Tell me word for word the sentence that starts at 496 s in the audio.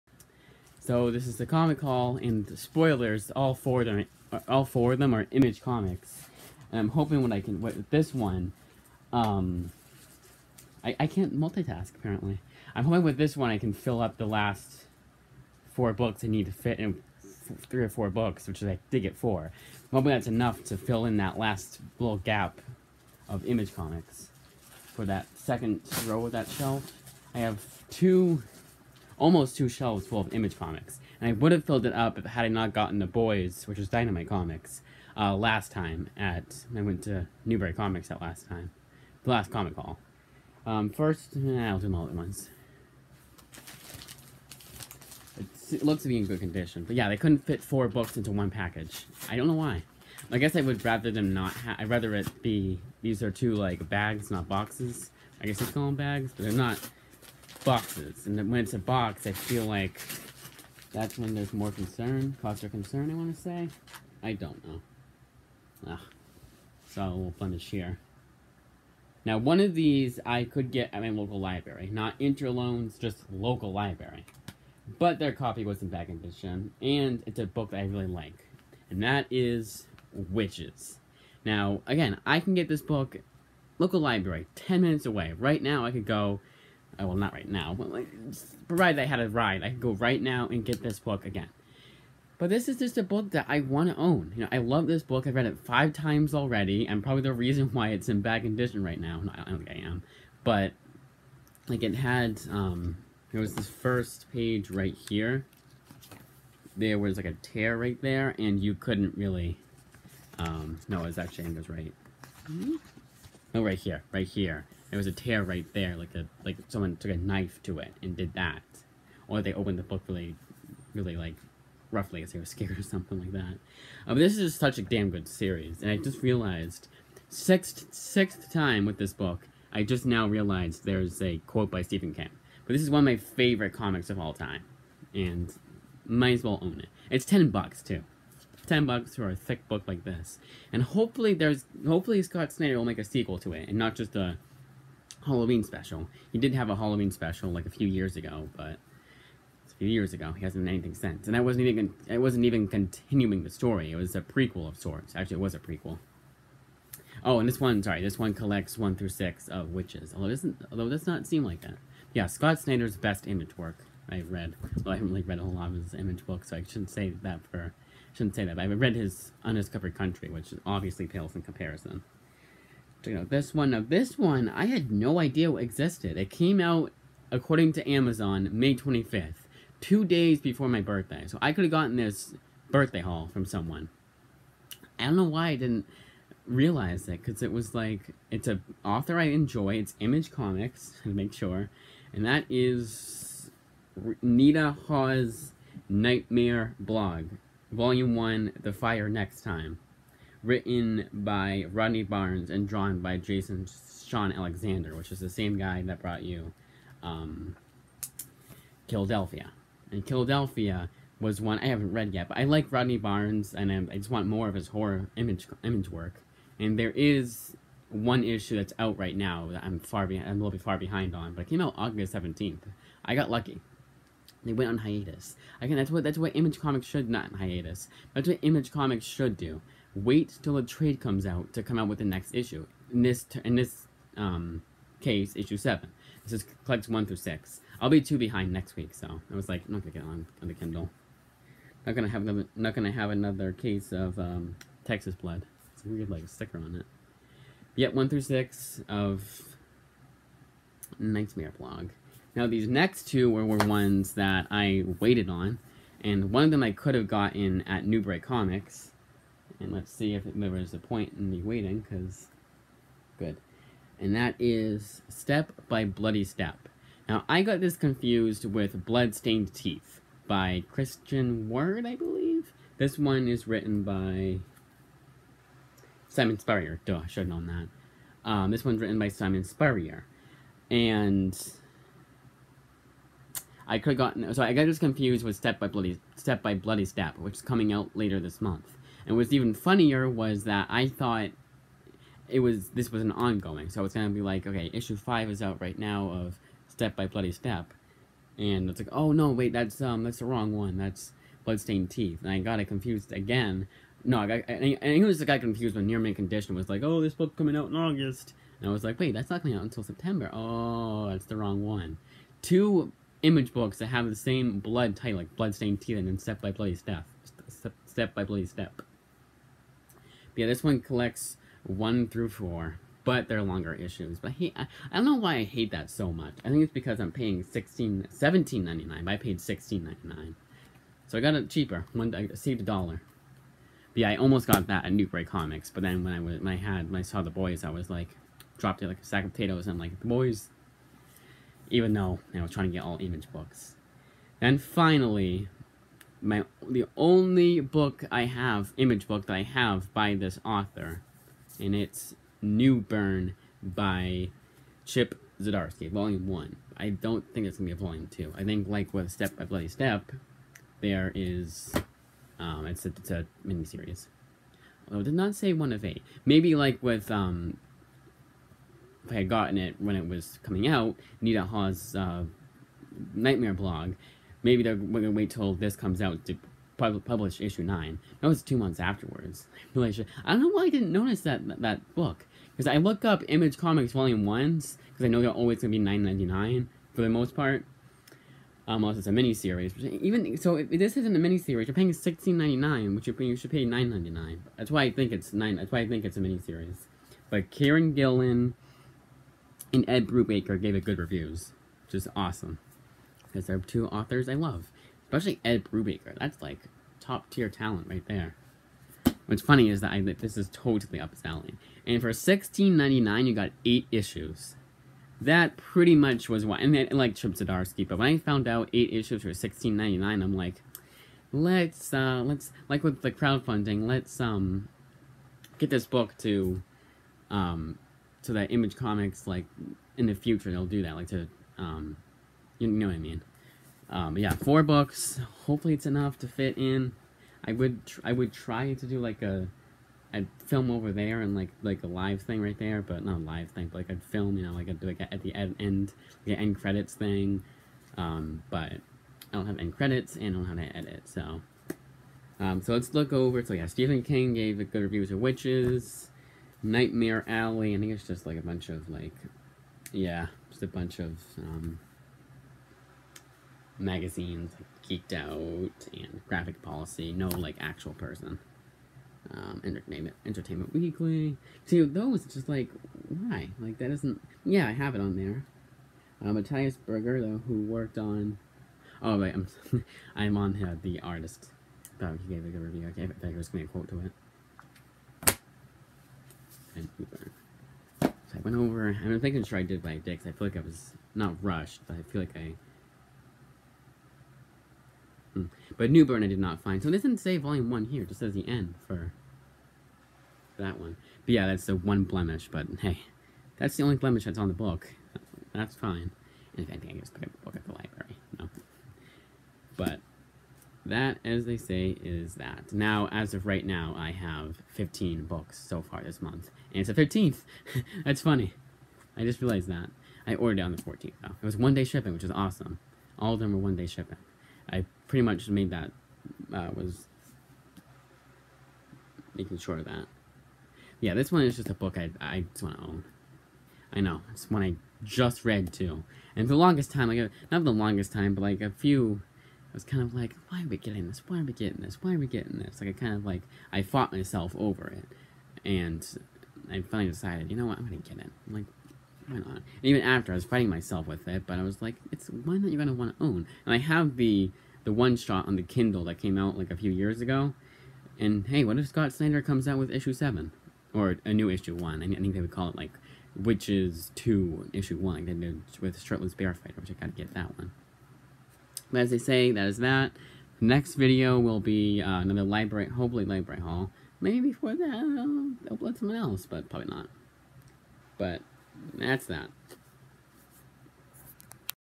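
So it doesn't say volume 1 here.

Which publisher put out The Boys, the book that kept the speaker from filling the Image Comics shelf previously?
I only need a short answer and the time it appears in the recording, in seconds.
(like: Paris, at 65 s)
Dynamite Comics, at 33 s.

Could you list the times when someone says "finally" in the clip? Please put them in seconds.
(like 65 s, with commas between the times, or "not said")
344 s, 546 s.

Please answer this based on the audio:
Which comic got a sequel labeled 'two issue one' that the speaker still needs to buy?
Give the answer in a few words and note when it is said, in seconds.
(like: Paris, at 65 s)
Shirtless Bear Fighter, at 566 s.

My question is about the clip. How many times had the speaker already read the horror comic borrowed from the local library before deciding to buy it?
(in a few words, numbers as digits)
5.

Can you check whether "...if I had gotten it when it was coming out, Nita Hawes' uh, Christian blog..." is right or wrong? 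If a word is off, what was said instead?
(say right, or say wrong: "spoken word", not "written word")
wrong: "Nightmare", not "Christian".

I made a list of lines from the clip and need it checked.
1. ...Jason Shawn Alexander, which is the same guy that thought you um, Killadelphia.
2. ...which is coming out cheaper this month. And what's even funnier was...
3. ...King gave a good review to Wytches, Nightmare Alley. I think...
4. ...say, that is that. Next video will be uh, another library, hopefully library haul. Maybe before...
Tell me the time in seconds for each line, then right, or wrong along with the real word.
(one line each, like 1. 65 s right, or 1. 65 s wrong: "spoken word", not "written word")
1. 203 s wrong: "brought", not "thought"
2. 287 s wrong: "later", not "cheaper"
3. 454 s right
4. 569 s right.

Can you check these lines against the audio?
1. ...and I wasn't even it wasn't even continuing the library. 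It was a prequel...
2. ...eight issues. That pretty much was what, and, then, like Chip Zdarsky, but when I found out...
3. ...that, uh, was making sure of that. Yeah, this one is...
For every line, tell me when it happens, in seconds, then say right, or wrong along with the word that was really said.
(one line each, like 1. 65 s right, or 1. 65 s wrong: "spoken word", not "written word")
1. 151 s wrong: "story", not "library"
2. 413 s right
3. 525 s right.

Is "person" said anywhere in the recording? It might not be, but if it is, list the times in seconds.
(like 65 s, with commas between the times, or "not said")
467 s.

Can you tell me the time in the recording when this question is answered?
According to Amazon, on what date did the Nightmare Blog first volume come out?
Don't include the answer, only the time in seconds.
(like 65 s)
178 s.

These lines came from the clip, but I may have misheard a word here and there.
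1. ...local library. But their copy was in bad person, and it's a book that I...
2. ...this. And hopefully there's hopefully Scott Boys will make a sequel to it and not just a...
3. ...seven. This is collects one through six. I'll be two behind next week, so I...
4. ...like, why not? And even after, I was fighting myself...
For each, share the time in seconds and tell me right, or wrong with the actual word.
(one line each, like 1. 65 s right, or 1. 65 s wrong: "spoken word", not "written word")
1. 73 s wrong: "condition", not "person"
2. 140 s wrong: "Snyder", not "Boys"
3. 235 s right
4. 548 s right.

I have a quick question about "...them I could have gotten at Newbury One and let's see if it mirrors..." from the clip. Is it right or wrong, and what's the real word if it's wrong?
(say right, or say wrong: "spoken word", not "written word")
wrong: "Comics", not "One".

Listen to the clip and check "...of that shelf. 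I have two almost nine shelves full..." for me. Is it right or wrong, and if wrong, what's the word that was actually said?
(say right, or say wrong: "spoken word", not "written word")
wrong: "two", not "nine".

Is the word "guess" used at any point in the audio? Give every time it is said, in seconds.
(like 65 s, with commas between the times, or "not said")
50 s, 55 s.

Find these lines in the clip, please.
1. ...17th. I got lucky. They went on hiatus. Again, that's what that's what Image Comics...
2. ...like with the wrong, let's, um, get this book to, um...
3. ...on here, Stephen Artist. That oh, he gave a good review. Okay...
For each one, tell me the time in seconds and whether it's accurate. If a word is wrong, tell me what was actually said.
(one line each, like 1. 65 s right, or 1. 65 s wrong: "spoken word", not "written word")
1. 222 s right
2. 422 s wrong: "crowdfunding", not "wrong"
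3. 480 s wrong: "The", not "Stephen".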